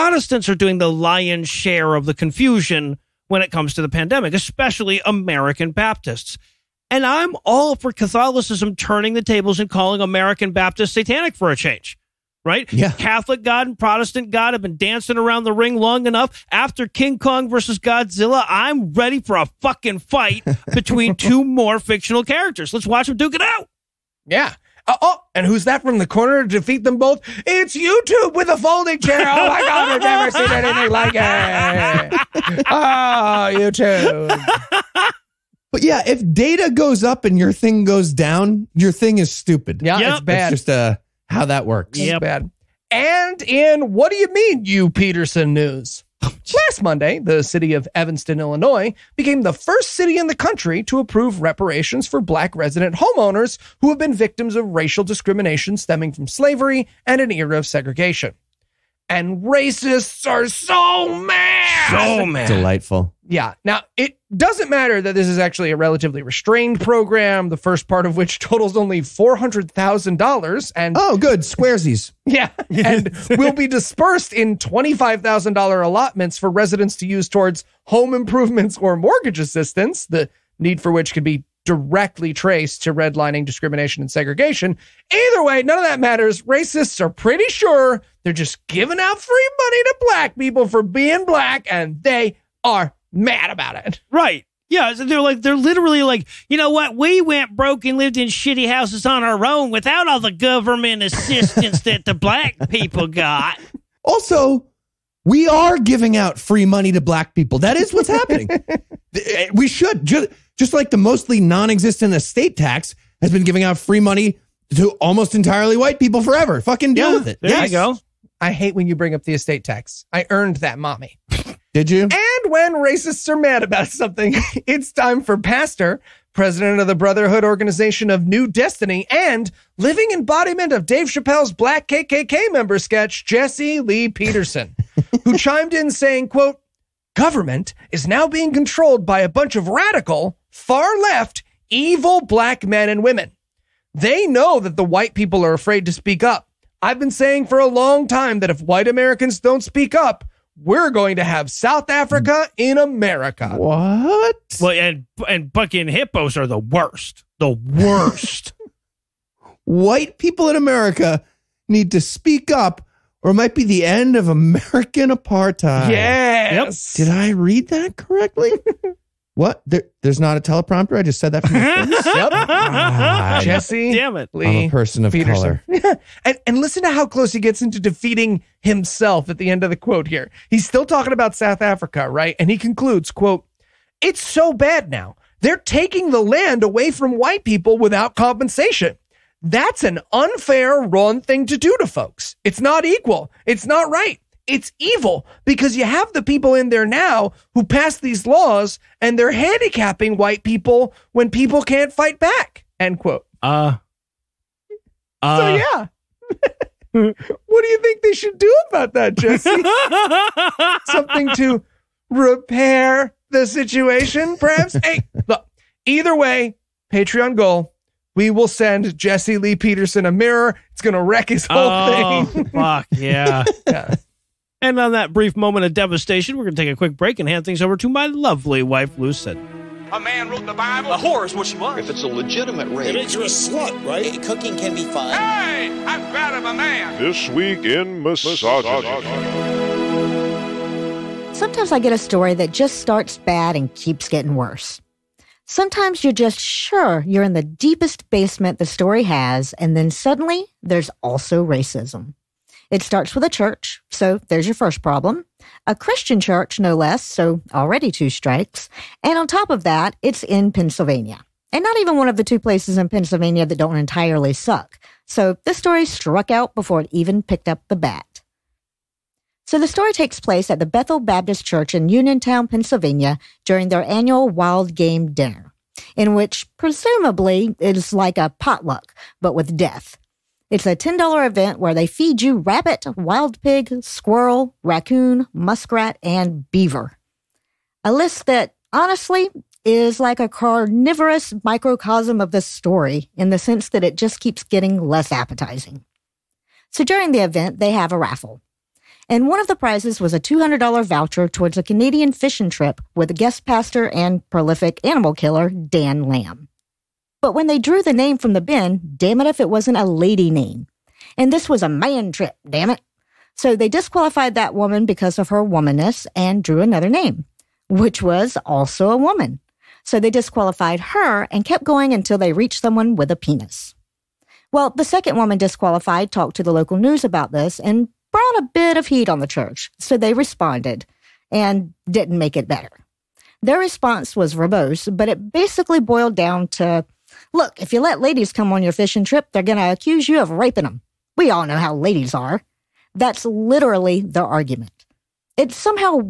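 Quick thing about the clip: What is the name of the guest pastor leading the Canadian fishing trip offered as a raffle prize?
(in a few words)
Dan Lamb.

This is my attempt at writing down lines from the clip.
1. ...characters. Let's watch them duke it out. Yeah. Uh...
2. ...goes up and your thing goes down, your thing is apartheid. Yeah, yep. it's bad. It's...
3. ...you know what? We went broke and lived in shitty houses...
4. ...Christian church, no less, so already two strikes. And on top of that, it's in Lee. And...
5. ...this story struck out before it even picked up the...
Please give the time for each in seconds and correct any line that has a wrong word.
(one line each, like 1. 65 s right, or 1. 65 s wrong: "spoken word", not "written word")
1. 22 s right
2. 36 s wrong: "stupid", not "apartheid"
3. 96 s right
4. 255 s wrong: "Pennsylvania", not "Lee"
5. 265 s right.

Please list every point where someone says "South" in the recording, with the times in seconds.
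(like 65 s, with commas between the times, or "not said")
151 s, 181 s.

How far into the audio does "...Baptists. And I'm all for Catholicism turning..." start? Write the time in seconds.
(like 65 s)
5 s.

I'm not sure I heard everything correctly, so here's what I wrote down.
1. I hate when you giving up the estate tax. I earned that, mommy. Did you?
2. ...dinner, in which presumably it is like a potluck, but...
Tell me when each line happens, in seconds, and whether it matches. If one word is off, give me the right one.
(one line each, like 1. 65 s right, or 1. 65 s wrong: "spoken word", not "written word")
1. 118 s wrong: "bring", not "giving"
2. 275 s right.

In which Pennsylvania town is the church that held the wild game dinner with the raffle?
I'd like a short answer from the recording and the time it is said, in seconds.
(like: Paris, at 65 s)
Uniontown, at 271 s.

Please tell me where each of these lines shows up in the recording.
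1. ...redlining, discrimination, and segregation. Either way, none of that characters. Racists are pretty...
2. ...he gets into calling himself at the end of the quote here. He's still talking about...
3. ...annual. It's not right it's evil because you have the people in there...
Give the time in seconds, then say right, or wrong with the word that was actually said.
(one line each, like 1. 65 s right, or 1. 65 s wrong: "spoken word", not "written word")
1. 82 s wrong: "matters", not "characters"
2. 177 s wrong: "defeating", not "calling"
3. 192 s wrong: "equal", not "annual".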